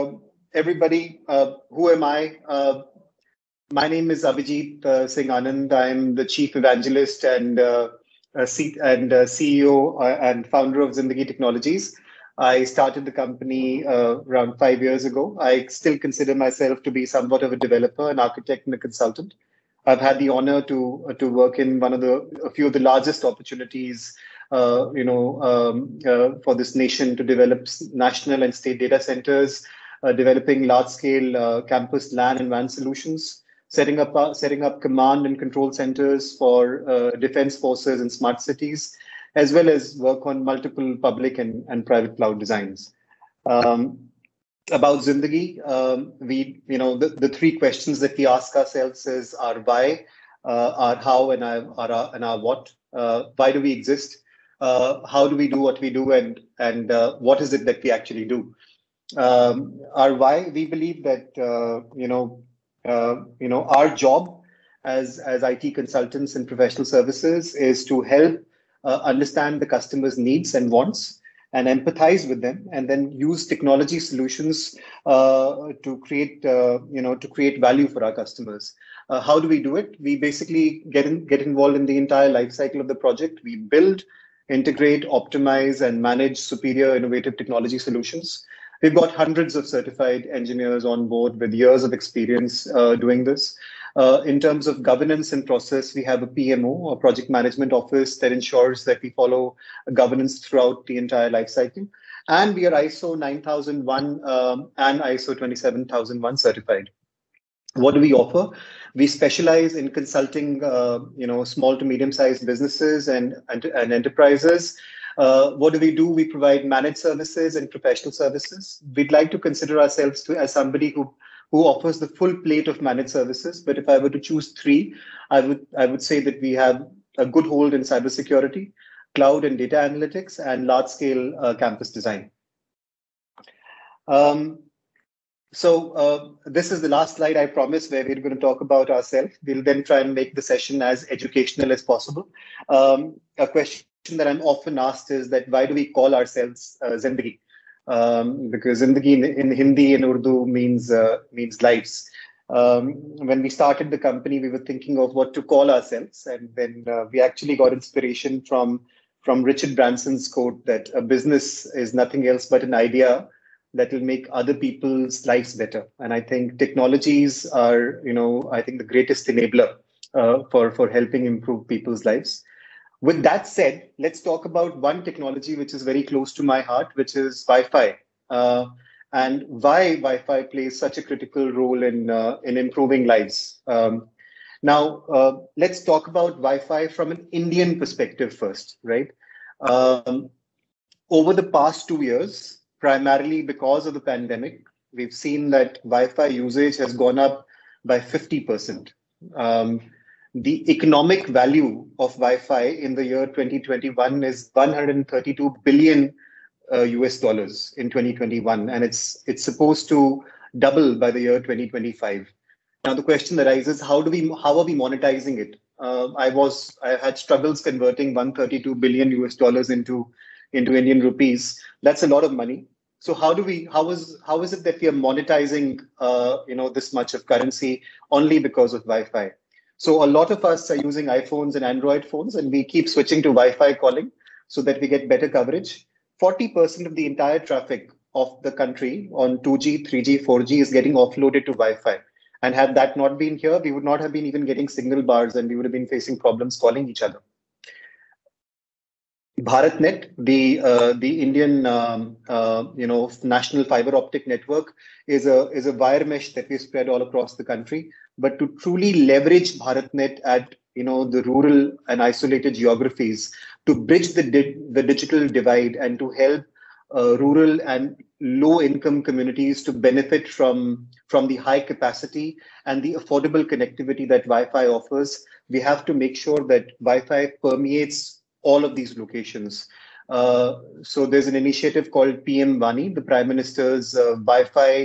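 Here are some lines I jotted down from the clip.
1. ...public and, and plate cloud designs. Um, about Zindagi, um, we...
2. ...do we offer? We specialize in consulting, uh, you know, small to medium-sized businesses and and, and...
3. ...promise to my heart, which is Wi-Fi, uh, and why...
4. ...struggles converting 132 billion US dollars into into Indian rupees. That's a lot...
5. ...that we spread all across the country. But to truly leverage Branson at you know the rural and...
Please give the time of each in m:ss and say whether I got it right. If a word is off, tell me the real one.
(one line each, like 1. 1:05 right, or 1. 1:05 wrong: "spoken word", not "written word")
1. 0:40 wrong: "private", not "plate"
2. 1:47 right
3. 2:56 wrong: "close", not "promise"
4. 3:37 right
5. 4:16 wrong: "BharatNet", not "Branson".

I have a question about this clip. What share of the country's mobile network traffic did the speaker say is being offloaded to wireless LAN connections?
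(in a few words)
40%.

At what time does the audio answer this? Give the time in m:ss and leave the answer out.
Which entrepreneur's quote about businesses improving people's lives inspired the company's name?
2:39.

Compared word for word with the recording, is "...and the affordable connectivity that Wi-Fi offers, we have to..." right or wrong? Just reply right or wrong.
right.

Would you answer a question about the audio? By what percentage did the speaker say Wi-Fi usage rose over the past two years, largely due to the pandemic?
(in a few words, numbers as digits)
50%.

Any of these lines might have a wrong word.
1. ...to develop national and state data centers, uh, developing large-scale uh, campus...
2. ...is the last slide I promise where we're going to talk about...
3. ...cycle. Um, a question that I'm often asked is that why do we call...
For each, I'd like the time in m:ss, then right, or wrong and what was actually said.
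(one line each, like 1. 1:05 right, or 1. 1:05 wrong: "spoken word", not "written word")
1. 0:27 right
2. 2:16 right
3. 2:21 wrong: "possible", not "cycle".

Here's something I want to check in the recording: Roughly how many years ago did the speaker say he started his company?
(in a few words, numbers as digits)
5 years.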